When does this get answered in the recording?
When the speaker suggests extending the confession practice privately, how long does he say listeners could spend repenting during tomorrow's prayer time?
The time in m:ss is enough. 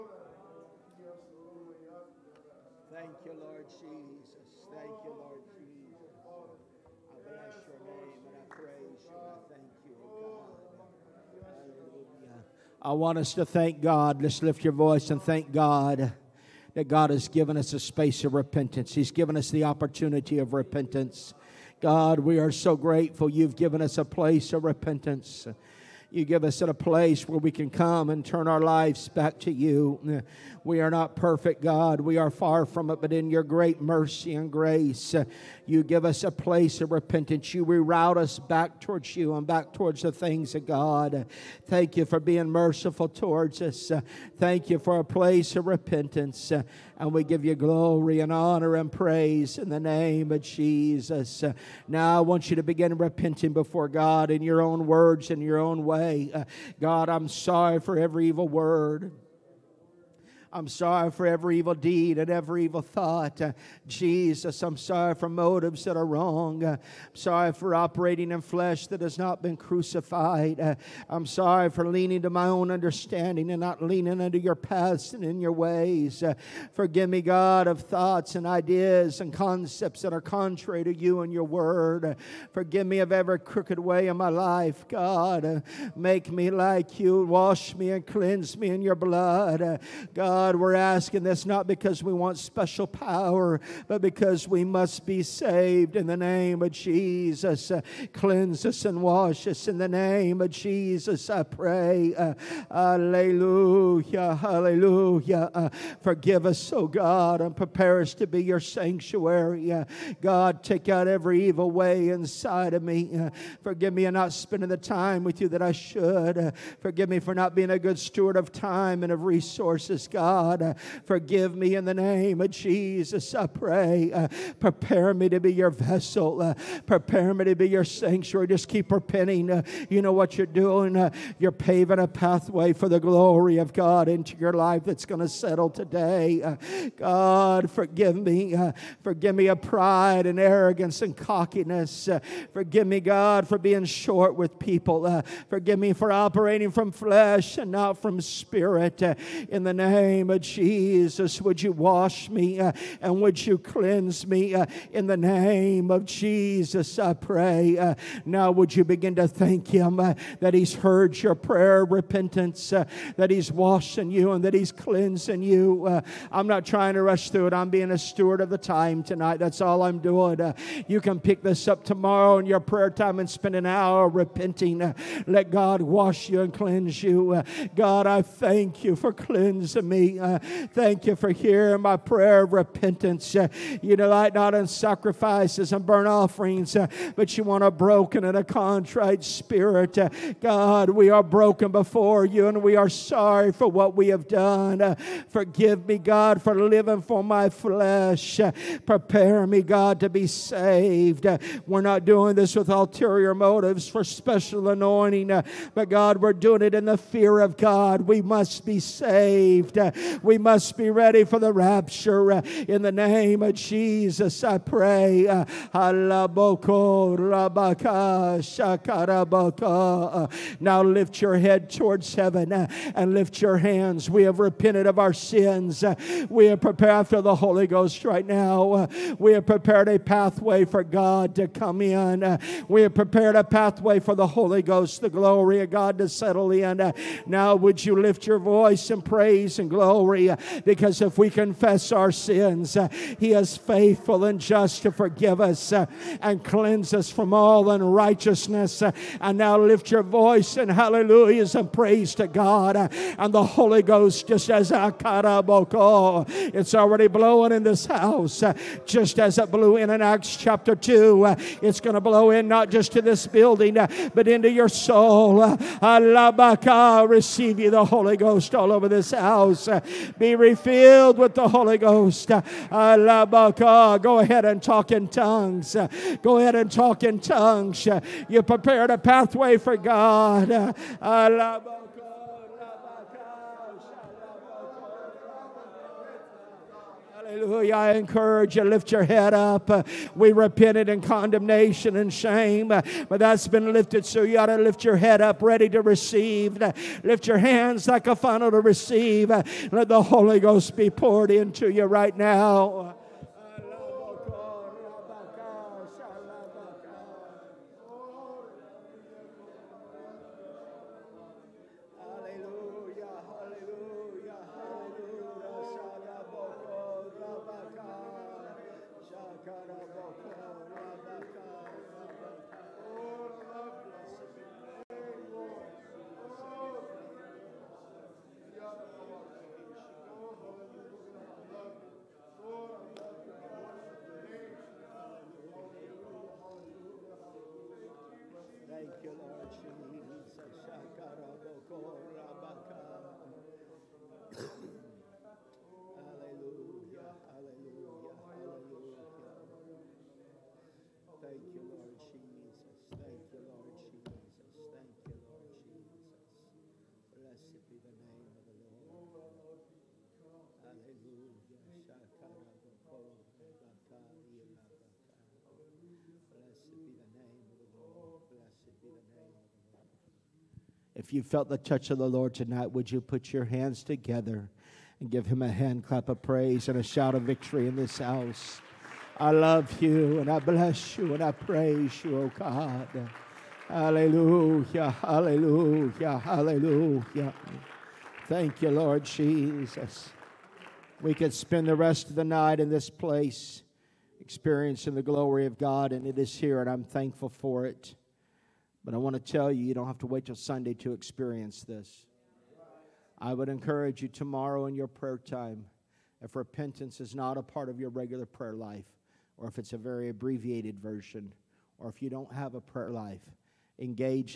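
2:53.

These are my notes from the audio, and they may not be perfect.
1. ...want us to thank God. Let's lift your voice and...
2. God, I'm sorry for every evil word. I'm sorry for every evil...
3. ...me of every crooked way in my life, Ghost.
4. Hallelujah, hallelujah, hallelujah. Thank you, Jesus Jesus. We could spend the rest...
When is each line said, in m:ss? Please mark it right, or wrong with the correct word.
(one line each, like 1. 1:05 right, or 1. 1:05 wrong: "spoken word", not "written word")
1. 0:12 right
2. 0:56 right
3. 1:22 wrong: "God", not "Ghost"
4. 6:23 wrong: "Lord", not "Jesus".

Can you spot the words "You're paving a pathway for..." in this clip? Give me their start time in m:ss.
2:11.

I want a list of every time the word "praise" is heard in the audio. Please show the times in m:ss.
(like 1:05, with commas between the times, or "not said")
0:48, 3:59, 4:11, 6:16, 6:21.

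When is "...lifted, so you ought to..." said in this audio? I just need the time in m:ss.
4:53.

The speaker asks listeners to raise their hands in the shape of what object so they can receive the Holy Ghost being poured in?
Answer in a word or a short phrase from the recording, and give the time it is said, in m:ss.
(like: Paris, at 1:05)
a funnel, at 4:58.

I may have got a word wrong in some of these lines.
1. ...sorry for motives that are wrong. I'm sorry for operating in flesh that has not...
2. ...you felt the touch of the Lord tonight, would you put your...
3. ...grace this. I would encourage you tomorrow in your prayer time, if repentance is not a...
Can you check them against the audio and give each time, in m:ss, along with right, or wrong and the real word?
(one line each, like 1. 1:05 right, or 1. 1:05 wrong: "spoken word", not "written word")
1. 1:04 right
2. 6:11 right
3. 6:40 wrong: "experience", not "grace".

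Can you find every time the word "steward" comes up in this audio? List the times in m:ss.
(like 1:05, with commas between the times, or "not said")
1:57, 2:47.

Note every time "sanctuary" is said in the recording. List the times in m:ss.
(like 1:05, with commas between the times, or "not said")
1:48, 2:07.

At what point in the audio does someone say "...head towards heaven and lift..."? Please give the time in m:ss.
3:41.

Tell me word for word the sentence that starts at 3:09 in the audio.
Uh, God, we are broken before you and we are sorry for what we have done.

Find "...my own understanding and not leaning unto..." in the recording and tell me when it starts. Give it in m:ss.
1:12.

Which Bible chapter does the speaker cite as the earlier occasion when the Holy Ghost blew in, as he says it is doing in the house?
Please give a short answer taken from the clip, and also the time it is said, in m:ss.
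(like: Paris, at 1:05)
Acts chapter 2, at 4:20.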